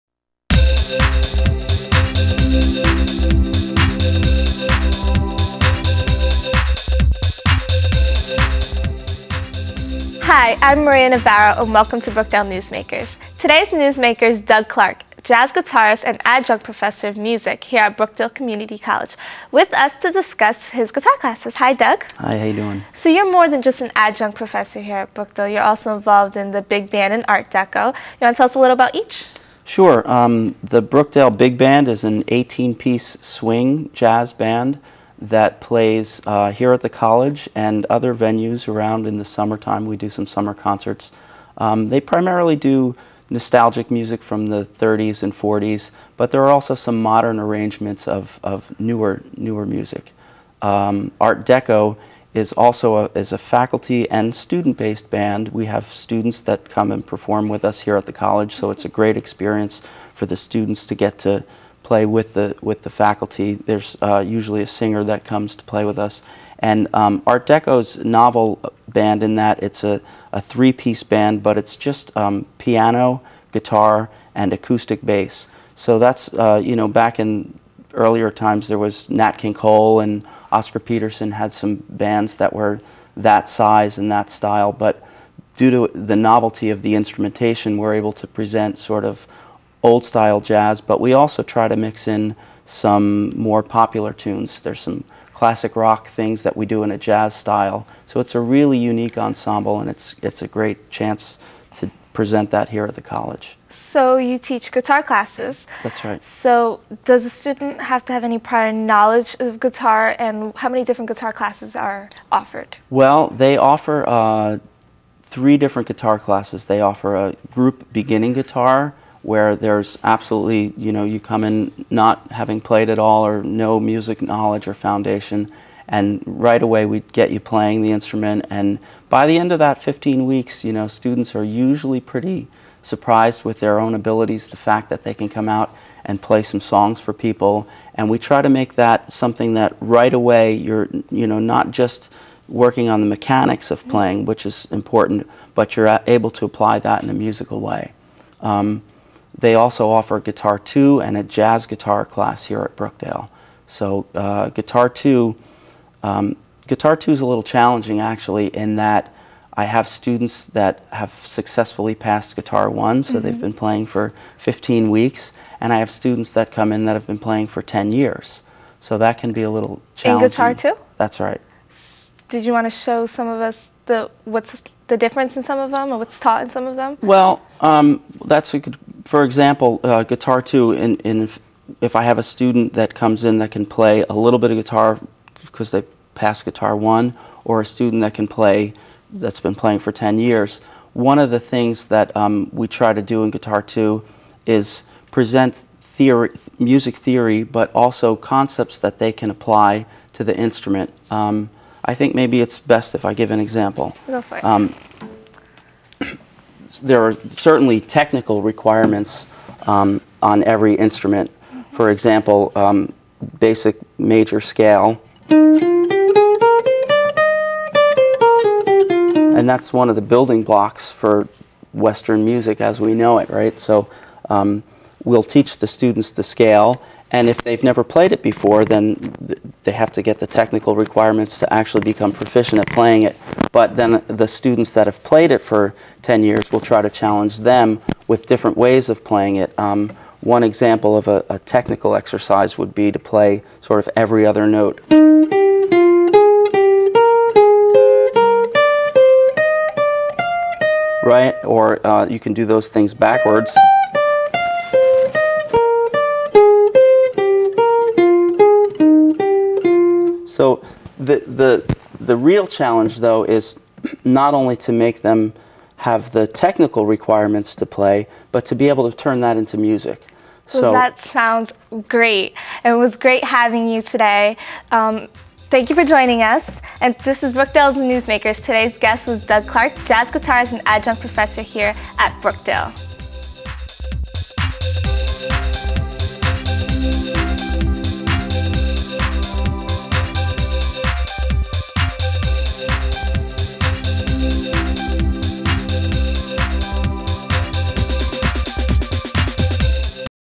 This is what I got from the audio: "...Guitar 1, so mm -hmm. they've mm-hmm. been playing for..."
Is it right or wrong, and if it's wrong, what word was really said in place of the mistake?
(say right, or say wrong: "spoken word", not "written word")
right.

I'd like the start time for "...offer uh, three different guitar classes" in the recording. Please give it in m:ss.
1:53.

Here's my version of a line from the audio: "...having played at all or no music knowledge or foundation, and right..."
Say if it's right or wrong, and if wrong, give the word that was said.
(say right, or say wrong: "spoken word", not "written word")
right.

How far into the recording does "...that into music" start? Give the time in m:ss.
4:29.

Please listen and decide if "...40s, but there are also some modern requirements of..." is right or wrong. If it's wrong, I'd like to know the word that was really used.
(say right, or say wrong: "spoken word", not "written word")
wrong: "arrangements", not "requirements".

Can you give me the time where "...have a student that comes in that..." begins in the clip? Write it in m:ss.
3:02.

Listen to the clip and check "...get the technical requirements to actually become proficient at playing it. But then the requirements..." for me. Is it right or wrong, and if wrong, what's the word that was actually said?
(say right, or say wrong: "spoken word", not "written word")
wrong: "students", not "requirements".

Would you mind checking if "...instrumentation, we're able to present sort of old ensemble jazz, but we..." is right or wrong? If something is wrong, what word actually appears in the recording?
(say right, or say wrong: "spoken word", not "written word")
wrong: "style", not "ensemble".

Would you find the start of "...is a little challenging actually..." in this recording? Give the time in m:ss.
2:37.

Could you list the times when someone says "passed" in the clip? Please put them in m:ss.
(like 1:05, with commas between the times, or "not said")
2:41, 3:06.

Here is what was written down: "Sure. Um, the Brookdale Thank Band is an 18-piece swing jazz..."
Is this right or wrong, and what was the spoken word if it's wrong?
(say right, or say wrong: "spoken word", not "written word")
wrong: "Big", not "Thank".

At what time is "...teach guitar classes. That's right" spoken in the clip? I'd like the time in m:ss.
1:44.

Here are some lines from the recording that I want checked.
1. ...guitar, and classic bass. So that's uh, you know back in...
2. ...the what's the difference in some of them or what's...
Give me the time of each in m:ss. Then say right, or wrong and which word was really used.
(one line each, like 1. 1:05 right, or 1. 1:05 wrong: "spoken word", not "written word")
1. 1:13 wrong: "acoustic", not "classic"
2. 2:53 right.